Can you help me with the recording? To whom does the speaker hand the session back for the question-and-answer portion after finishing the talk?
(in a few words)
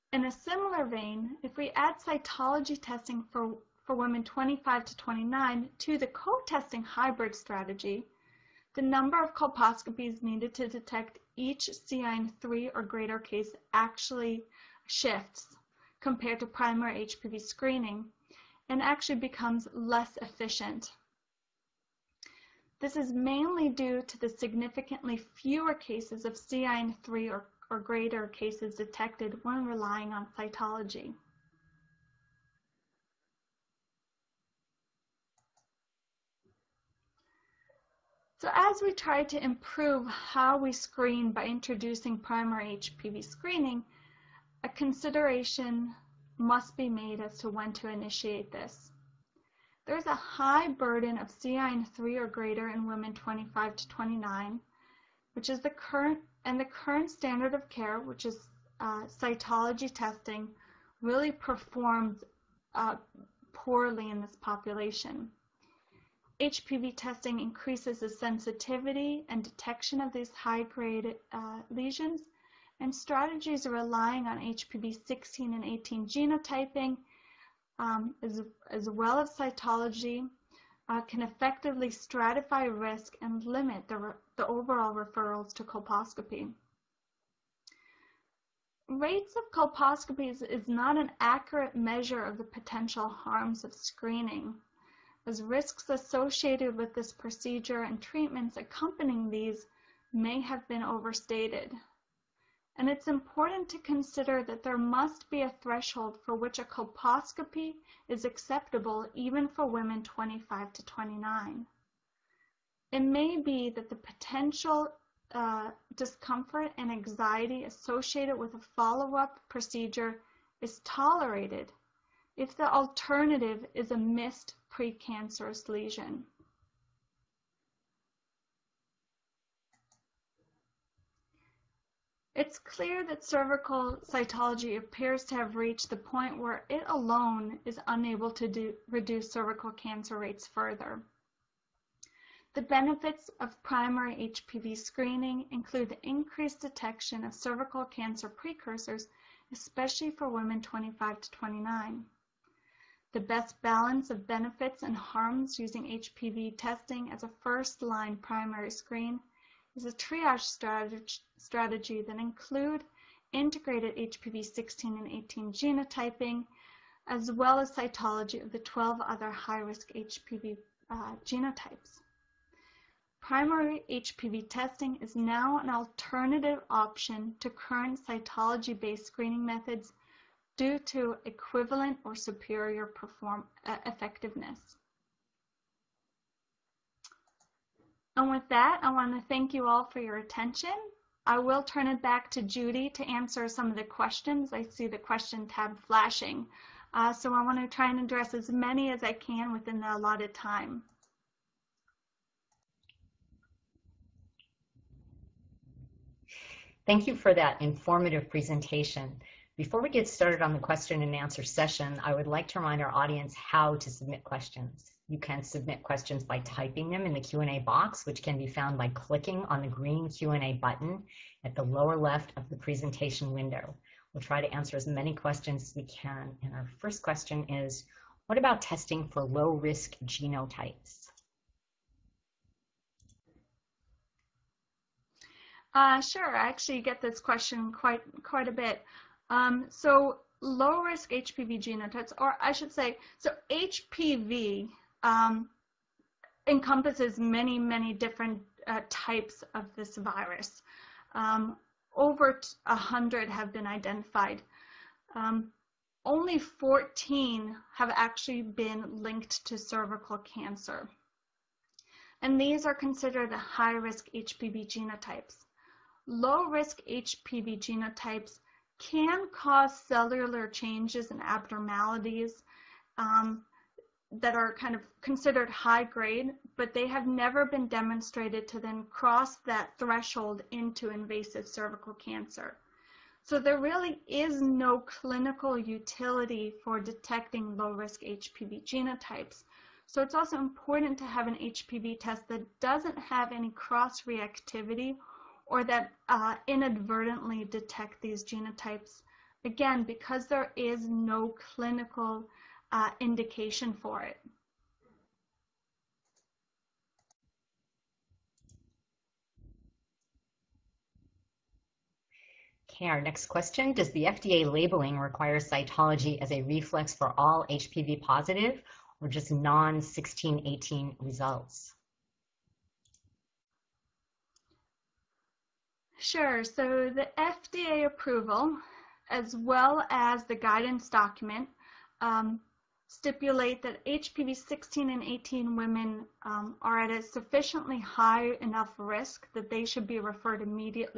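Judy.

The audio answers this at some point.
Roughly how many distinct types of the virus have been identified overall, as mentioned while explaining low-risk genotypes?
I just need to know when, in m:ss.
4:11.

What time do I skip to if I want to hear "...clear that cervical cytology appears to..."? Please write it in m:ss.
2:12.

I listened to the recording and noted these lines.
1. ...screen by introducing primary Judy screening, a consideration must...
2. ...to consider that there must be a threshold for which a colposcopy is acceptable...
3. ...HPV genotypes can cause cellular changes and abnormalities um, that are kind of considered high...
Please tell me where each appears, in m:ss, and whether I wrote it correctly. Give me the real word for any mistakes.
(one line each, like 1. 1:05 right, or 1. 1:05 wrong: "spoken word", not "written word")
1. 0:40 wrong: "HPV", not "Judy"
2. 1:43 right
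3. 4:26 right.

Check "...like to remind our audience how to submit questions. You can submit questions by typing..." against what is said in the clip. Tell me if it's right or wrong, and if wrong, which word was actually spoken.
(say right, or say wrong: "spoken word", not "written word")
right.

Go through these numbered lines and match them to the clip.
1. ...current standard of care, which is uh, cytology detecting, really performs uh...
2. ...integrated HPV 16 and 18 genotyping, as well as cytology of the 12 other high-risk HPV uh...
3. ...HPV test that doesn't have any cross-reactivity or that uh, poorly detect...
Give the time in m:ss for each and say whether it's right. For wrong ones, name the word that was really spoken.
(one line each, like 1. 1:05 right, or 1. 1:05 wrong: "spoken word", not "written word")
1. 0:56 wrong: "testing", not "detecting"
2. 2:43 right
3. 4:51 wrong: "inadvertently", not "poorly".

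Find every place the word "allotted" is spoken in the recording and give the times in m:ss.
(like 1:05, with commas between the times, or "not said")
3:19.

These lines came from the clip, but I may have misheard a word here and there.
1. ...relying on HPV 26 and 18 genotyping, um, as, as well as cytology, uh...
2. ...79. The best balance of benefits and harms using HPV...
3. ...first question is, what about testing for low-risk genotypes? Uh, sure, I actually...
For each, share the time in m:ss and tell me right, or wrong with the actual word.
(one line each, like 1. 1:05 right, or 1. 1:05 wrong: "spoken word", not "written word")
1. 1:13 wrong: "16", not "26"
2. 2:31 wrong: "29", not "79"
3. 3:46 right.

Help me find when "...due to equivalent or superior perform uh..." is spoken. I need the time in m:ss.
3:00.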